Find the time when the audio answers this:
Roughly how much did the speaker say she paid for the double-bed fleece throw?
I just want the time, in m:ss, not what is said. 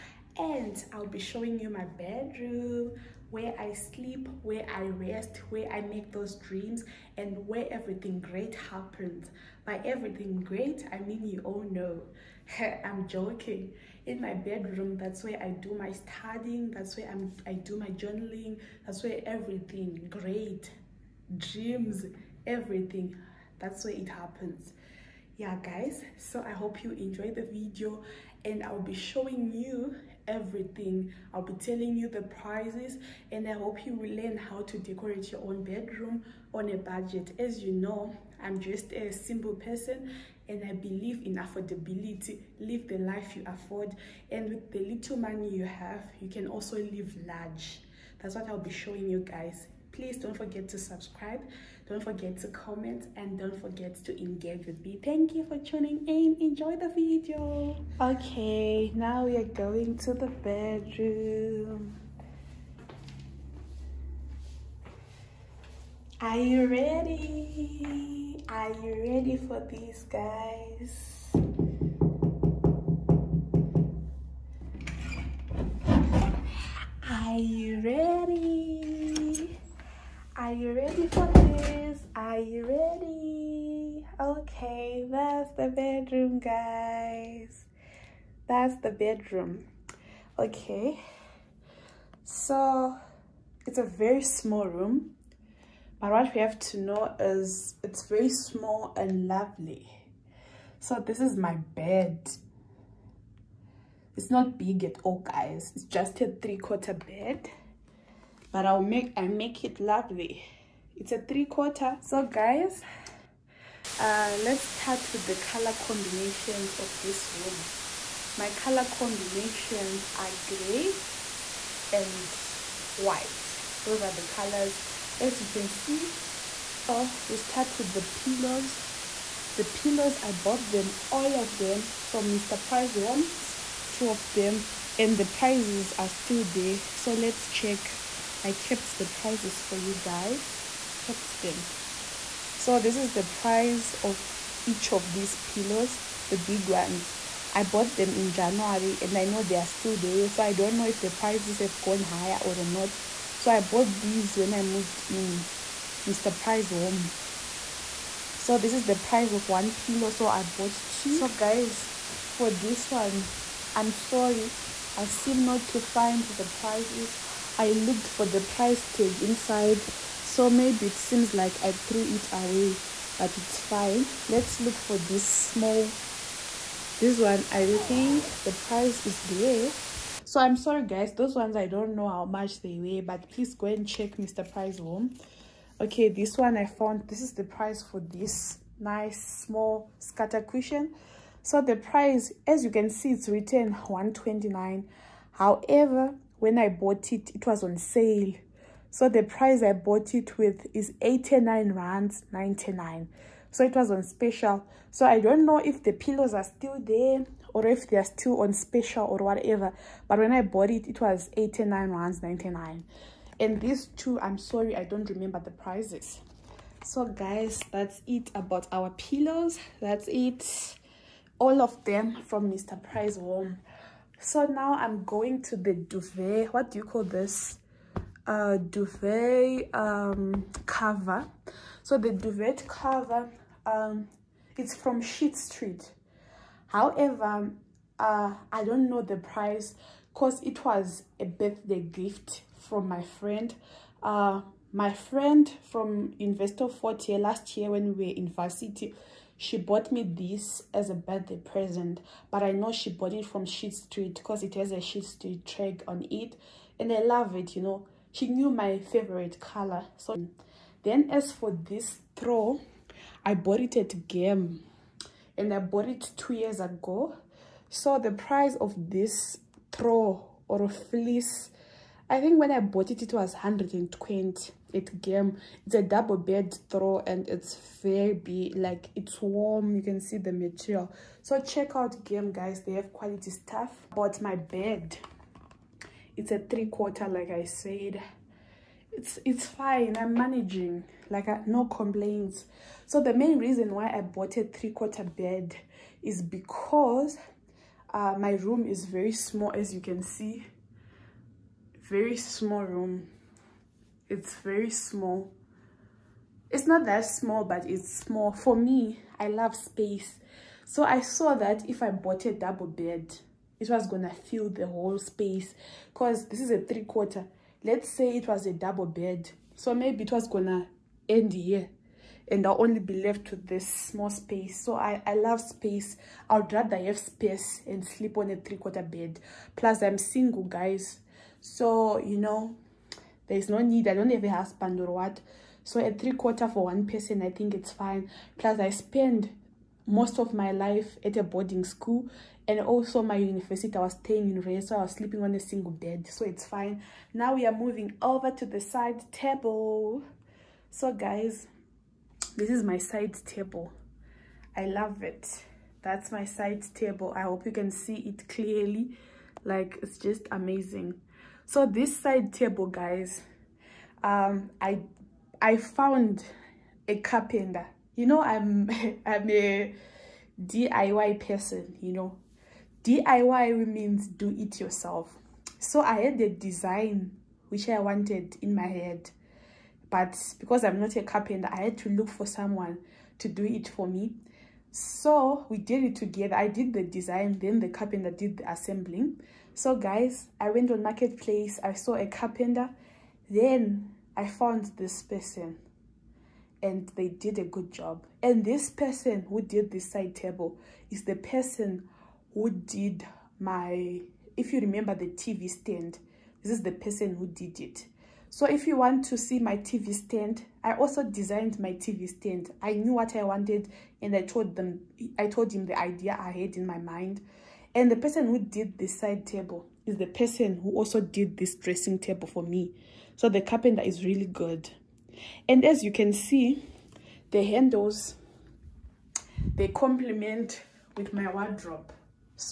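4:33.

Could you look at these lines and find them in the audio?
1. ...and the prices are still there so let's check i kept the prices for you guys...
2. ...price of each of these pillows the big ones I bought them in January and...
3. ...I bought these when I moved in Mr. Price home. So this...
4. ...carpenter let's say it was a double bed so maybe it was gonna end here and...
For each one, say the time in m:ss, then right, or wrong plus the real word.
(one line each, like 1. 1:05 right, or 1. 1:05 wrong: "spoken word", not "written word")
1. 2:14 right
2. 2:23 right
3. 2:33 right
4. 5:16 wrong: "quarter", not "carpenter".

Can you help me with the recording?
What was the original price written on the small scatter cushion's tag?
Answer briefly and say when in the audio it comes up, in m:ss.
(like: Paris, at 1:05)
129, at 3:13.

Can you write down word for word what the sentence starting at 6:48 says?
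So if you want to see my TV stand, I also designed my TV stand.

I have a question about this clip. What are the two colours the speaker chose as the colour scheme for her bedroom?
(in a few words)
Gray and white.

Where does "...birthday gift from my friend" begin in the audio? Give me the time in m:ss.
4:01.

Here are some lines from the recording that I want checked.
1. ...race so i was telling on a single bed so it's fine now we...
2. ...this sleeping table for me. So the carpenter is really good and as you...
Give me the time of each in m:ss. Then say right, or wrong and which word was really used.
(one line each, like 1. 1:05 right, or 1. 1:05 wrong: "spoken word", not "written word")
1. 5:44 wrong: "sleeping", not "telling"
2. 7:01 wrong: "dressing", not "sleeping".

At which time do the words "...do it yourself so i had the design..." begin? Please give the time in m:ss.
6:14.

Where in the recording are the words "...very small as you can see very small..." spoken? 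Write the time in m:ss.
4:58.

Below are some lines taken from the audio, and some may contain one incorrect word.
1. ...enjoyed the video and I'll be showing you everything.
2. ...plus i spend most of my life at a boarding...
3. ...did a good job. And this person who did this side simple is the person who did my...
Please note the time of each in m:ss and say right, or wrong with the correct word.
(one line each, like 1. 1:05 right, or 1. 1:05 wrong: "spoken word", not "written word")
1. 0:26 right
2. 5:38 right
3. 6:37 wrong: "table", not "simple".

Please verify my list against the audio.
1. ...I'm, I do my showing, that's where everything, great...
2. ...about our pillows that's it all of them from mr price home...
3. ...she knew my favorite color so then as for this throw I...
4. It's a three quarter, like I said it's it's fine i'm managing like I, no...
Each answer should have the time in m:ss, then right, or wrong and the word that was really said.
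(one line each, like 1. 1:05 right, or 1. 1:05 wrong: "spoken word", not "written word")
1. 0:17 wrong: "journaling", not "showing"
2. 3:38 right
3. 4:18 right
4. 4:46 right.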